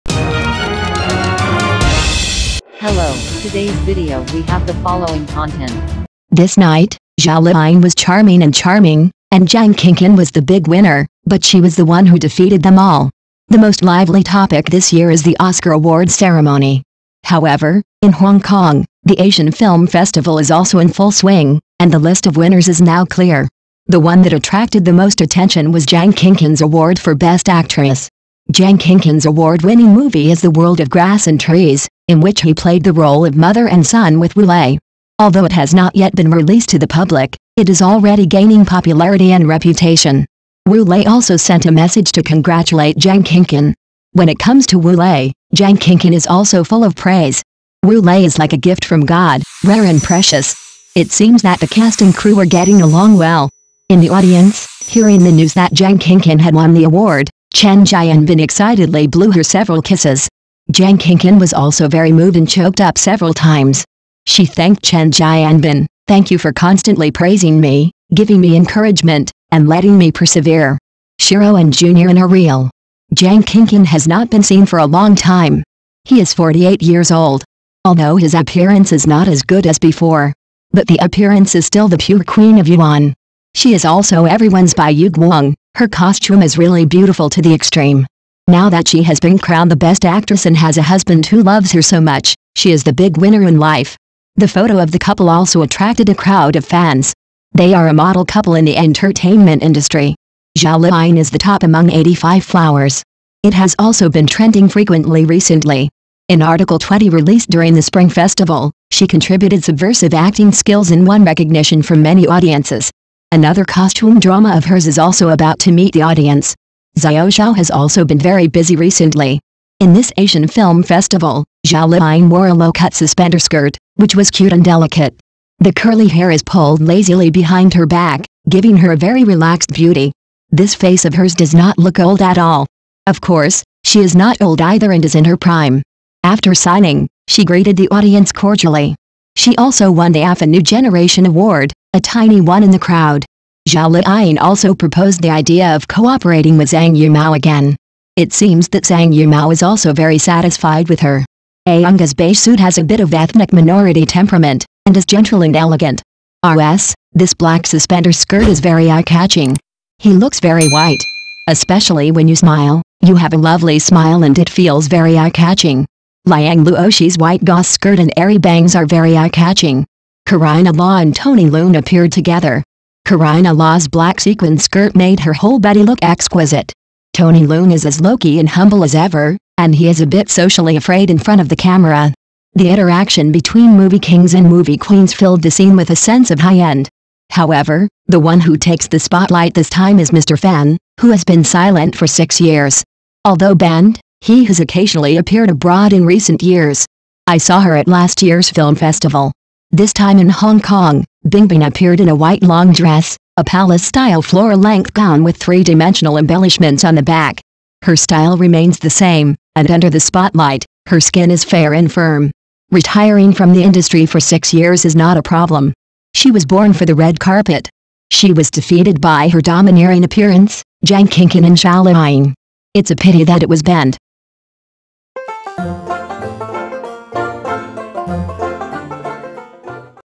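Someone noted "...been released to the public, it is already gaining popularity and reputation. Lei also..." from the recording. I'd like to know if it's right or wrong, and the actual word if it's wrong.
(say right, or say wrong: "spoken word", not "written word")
right.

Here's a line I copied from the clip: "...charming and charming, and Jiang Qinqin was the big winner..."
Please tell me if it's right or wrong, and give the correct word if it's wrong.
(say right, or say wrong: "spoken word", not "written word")
right.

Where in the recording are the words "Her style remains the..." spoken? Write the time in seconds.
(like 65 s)
207 s.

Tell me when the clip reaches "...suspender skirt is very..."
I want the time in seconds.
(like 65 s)
157 s.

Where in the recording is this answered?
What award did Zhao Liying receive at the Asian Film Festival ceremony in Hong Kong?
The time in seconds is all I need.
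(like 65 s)
140 s.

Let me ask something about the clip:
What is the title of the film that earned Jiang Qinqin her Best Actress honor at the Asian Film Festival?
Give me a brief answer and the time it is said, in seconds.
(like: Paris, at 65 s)
The World of Grass and Trees, at 30 s.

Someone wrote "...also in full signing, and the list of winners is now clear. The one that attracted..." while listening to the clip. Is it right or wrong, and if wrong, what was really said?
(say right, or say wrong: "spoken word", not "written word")
wrong: "swing", not "signing".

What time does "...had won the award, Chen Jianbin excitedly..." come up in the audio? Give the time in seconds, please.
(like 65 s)
56 s.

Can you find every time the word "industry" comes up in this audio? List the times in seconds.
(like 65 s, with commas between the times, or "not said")
99 s, 213 s.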